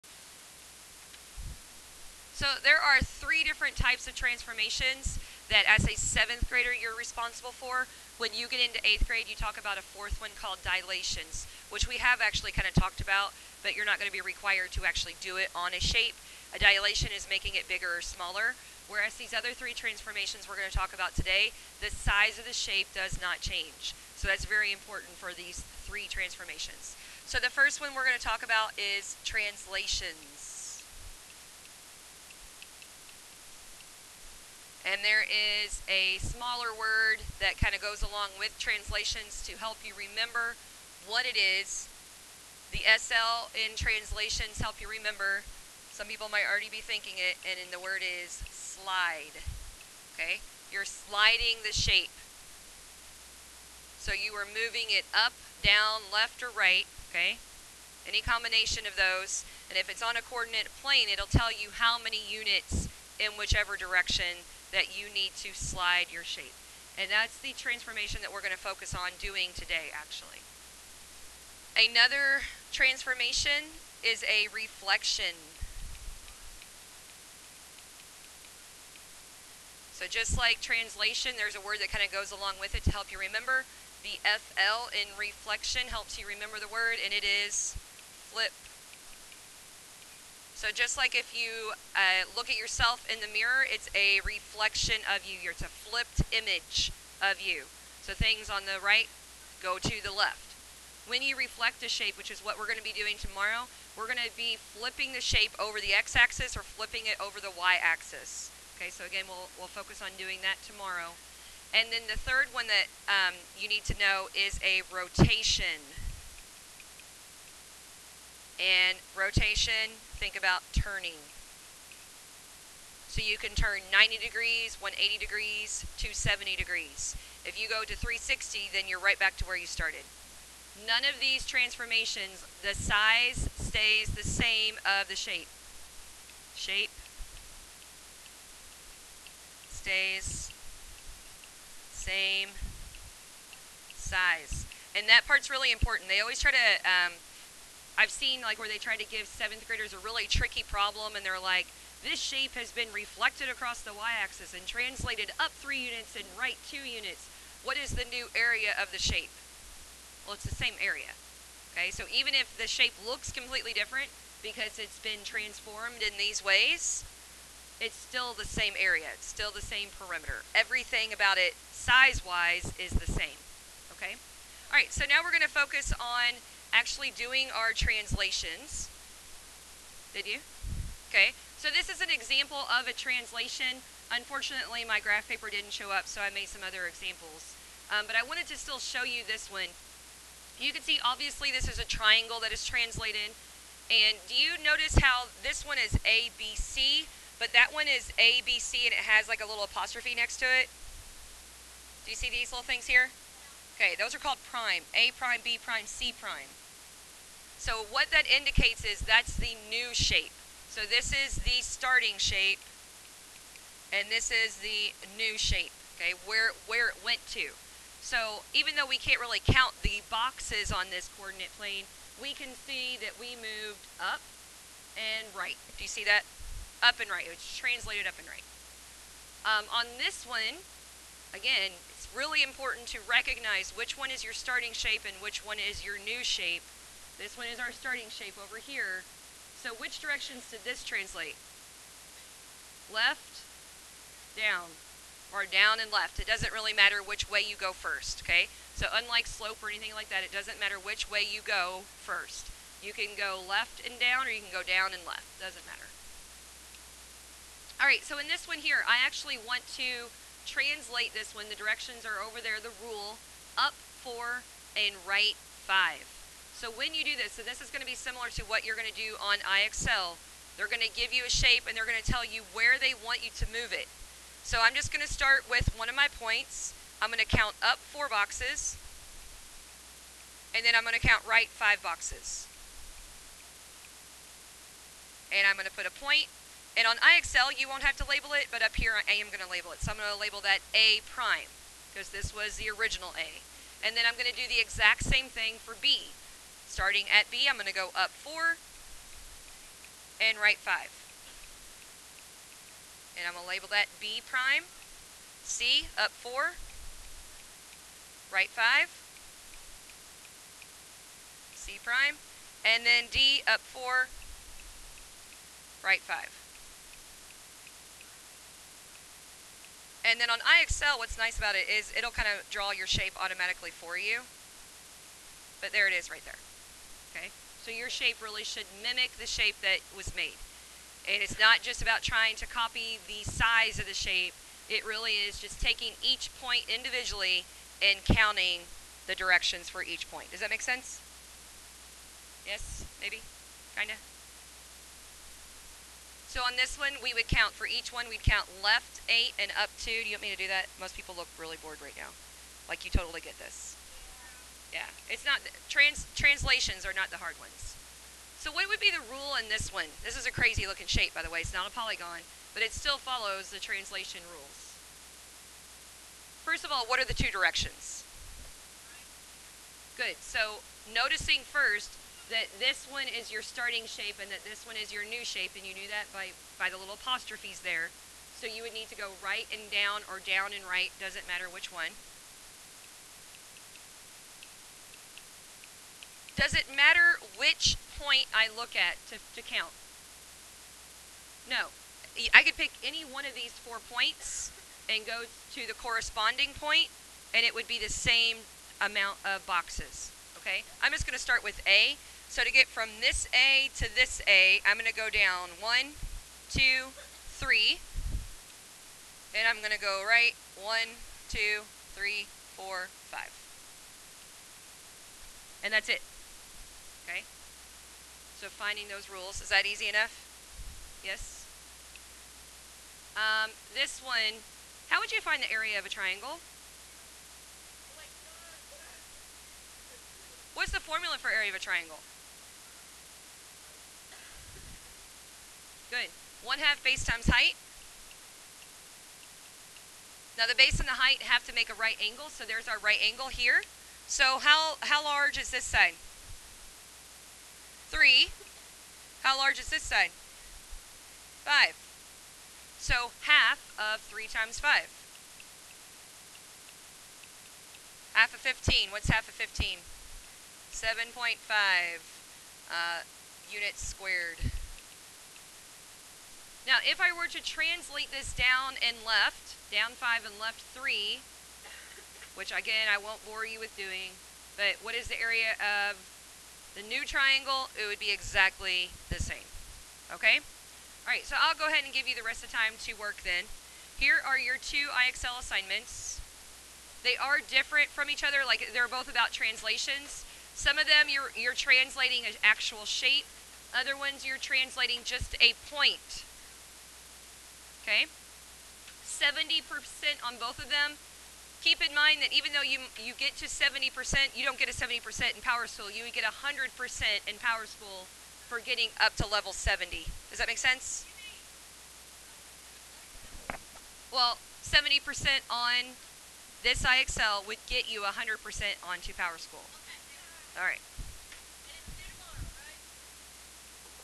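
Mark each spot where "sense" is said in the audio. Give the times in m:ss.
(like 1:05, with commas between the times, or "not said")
5:40, 8:30.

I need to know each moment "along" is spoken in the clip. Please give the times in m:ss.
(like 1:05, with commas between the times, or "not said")
0:38, 1:22.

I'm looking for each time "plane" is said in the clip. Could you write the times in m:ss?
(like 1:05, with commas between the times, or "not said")
1:00, 3:41.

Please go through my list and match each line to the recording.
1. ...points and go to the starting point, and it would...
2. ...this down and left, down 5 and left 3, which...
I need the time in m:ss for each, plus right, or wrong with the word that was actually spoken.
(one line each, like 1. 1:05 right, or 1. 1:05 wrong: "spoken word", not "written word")
1. 6:33 wrong: "corresponding", not "starting"
2. 7:48 right.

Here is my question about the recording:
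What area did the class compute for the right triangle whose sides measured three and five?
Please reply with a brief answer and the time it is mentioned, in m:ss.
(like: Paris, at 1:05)
7.5 units squared, at 7:40.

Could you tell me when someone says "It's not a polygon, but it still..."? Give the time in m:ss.
6:01.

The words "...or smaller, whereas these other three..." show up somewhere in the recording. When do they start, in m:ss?
0:17.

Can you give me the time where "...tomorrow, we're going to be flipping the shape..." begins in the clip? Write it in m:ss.
1:43.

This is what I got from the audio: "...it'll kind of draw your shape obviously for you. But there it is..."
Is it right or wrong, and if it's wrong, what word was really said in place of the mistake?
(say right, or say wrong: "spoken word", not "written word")
wrong: "automatically", not "obviously".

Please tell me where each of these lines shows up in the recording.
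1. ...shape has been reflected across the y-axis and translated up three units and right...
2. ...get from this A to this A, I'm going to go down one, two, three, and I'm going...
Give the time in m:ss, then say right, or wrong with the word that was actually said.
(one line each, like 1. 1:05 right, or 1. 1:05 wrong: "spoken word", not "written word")
1. 2:32 right
2. 6:42 right.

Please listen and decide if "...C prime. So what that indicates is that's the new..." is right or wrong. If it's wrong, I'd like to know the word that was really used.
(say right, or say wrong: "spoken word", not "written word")
right.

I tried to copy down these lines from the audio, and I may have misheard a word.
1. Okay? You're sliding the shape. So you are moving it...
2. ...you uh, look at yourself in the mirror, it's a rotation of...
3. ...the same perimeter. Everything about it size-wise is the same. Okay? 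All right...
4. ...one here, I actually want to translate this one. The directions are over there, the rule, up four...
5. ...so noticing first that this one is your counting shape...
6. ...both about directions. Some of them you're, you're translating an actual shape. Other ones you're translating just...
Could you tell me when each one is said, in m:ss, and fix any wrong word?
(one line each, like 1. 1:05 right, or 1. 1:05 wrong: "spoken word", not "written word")
1. 0:50 right
2. 1:31 wrong: "reflection", not "rotation"
3. 2:49 right
4. 4:18 right
5. 6:10 wrong: "starting", not "counting"
6. 8:08 wrong: "translations", not "directions".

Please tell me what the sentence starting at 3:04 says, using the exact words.
Unfortunately, my graph paper didn't show up, so I made some other examples.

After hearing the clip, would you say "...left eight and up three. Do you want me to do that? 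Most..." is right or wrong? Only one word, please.
wrong.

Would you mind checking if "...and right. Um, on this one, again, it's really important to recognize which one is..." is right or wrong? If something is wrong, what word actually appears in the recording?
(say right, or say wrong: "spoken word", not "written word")
right.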